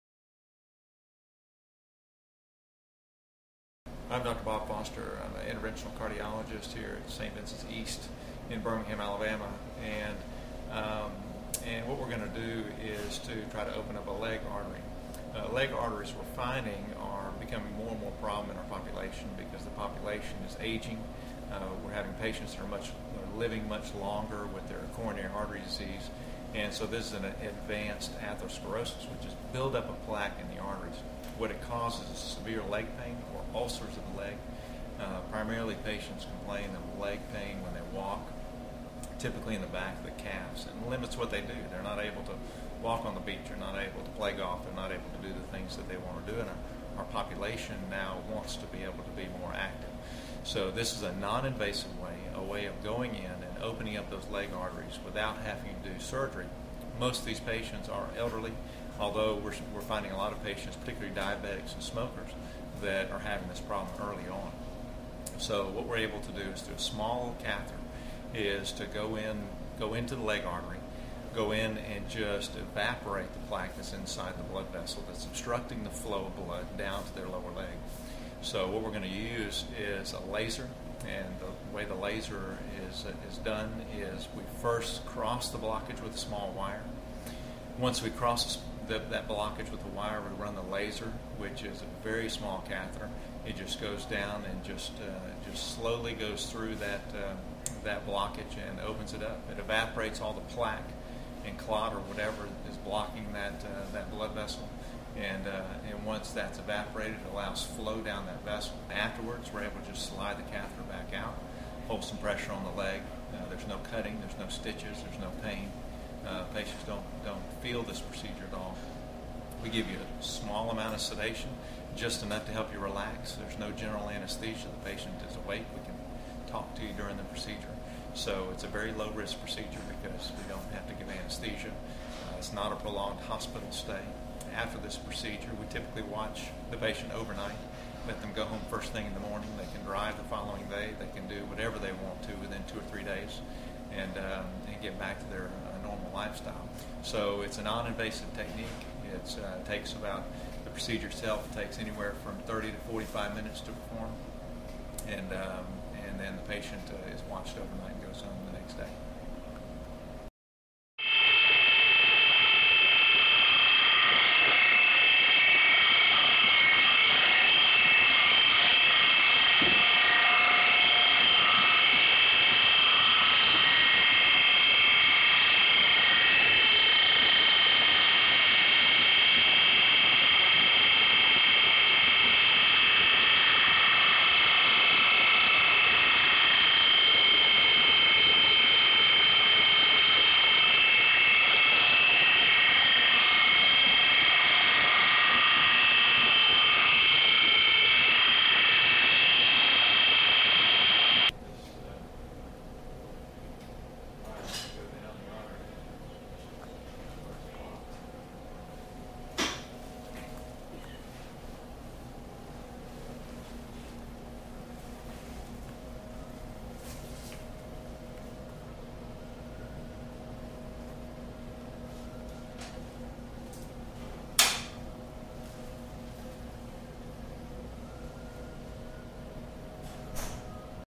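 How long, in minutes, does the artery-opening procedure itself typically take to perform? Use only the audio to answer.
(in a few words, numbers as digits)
30 to 45 minutes.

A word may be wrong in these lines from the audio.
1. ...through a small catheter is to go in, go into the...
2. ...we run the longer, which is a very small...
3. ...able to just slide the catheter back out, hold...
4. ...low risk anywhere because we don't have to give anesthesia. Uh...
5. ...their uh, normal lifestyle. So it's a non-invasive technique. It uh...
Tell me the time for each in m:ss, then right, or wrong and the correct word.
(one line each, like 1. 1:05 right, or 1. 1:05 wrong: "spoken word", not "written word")
1. 1:06 right
2. 1:30 wrong: "laser", not "longer"
3. 1:49 right
4. 2:08 wrong: "procedure", not "anywhere"
5. 2:25 right.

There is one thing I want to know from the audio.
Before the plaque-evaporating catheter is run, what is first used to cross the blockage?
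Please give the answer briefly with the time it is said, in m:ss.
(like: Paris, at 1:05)
small wire, at 1:26.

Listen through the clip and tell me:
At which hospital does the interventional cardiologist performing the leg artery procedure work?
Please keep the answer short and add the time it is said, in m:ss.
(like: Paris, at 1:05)
St. Vincent's East, at 0:07.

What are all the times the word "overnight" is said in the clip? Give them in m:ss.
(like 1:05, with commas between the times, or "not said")
2:17, 2:37.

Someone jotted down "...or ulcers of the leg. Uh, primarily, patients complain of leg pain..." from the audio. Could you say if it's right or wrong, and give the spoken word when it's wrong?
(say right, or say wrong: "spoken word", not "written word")
right.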